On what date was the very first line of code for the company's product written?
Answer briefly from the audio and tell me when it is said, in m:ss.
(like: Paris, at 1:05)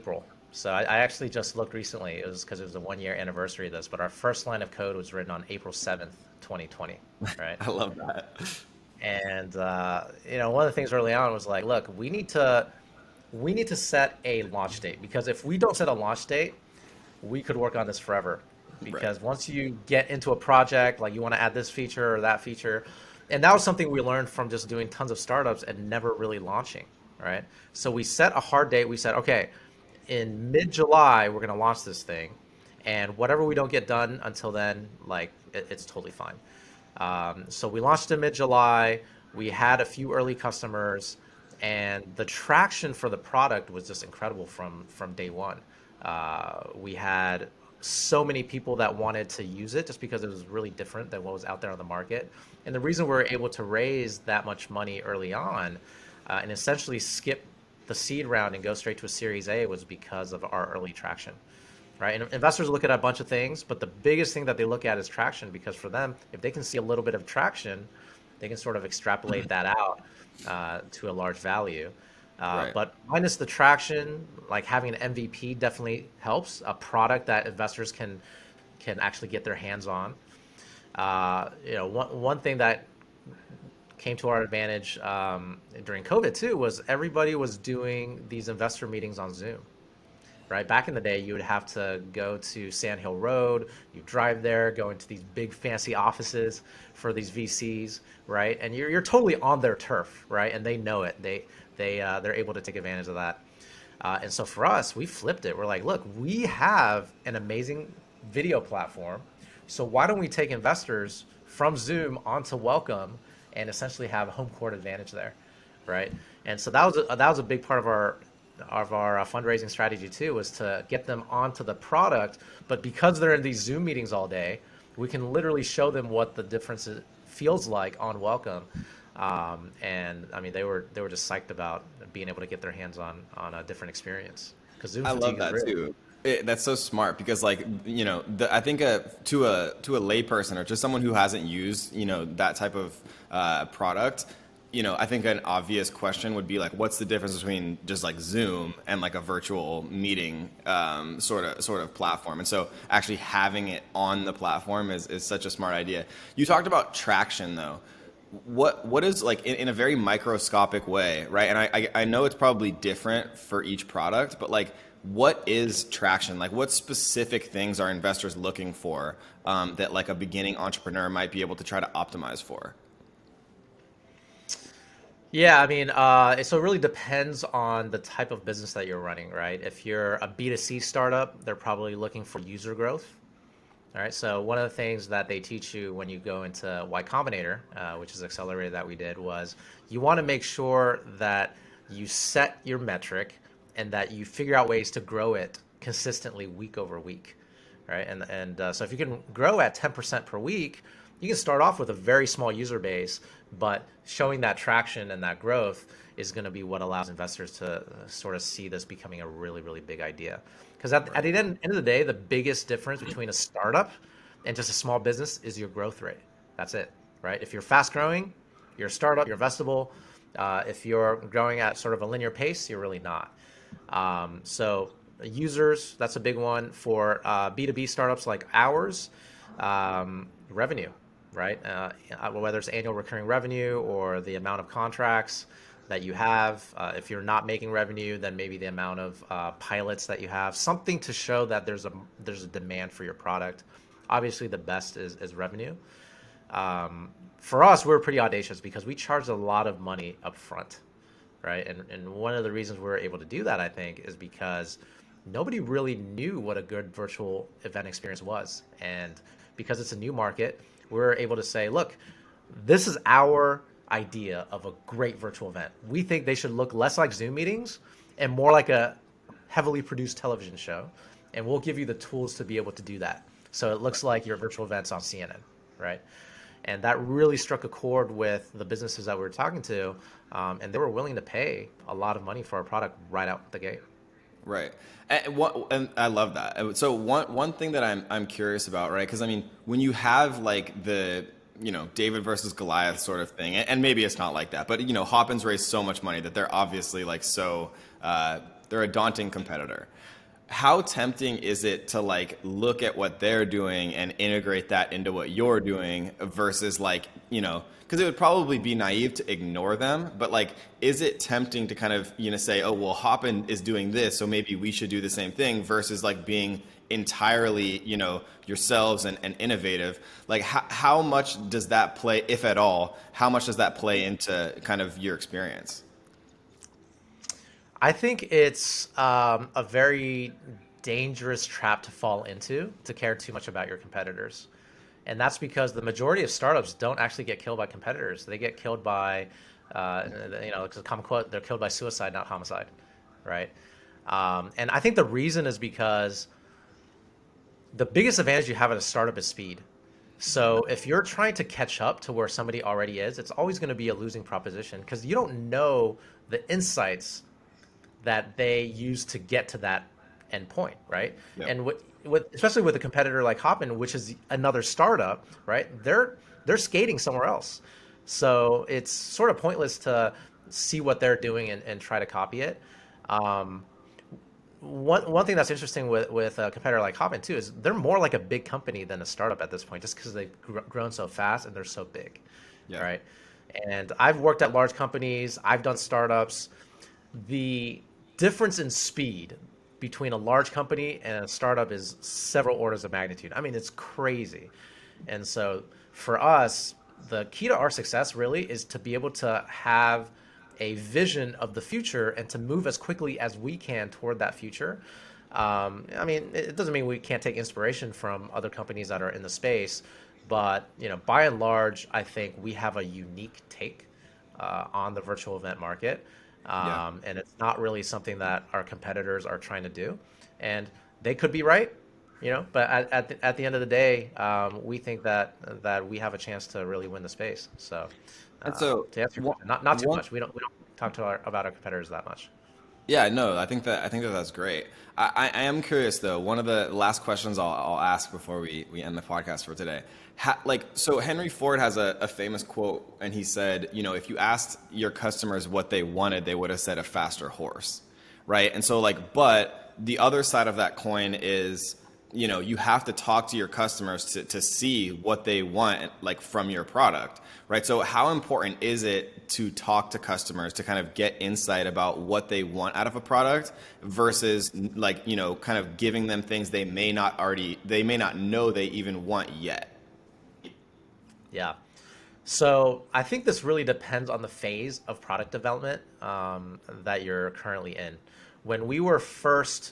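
April 7th, 2020, at 0:05.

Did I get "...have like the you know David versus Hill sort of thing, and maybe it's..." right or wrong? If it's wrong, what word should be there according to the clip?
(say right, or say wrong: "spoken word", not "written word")
wrong: "Goliath", not "Hill".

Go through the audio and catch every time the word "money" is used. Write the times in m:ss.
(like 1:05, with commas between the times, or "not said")
0:54, 4:09, 4:42, 4:56.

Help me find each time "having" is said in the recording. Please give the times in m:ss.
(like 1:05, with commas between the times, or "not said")
1:14, 2:33.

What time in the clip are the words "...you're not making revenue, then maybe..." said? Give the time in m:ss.
3:57.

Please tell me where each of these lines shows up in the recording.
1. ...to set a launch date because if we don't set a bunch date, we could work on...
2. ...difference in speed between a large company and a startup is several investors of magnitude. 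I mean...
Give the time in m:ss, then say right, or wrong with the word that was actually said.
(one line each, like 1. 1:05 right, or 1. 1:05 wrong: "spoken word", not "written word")
1. 0:13 wrong: "launch", not "bunch"
2. 6:28 wrong: "orders", not "investors".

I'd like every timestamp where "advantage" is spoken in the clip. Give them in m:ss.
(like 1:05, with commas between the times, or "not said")
1:24, 1:42, 1:54, 5:48.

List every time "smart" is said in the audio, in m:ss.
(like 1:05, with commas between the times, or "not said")
2:16, 2:35.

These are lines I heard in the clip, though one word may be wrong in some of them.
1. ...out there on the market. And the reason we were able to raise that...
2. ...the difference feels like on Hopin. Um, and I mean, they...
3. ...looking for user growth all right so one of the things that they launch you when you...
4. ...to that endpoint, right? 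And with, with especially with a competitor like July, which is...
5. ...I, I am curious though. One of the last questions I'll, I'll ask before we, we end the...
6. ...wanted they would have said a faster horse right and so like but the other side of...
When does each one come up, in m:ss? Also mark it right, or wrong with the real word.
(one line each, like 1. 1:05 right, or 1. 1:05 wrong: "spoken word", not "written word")
1. 0:51 right
2. 2:06 wrong: "Welcome", not "Hopin"
3. 3:01 wrong: "teach", not "launch"
4. 5:59 wrong: "Hopin", not "July"
5. 7:15 right
6. 7:25 right.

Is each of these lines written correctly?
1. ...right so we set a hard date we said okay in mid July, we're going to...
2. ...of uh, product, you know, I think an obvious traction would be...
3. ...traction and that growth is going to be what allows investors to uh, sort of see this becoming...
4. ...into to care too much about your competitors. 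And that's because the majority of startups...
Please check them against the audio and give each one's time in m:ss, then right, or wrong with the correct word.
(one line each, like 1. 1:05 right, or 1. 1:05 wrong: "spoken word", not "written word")
1. 0:27 right
2. 2:22 wrong: "question", not "traction"
3. 3:24 right
4. 5:32 right.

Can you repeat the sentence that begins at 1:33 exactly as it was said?
You drive there, go into these big fancy offices for these VCs, right?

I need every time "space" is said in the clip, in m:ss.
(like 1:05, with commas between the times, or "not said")
6:49, 7:07.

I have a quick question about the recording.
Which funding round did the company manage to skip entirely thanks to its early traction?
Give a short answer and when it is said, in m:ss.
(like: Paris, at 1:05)
seed round, at 0:57.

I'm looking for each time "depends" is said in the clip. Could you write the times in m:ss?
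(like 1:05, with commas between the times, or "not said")
2:56, 7:53.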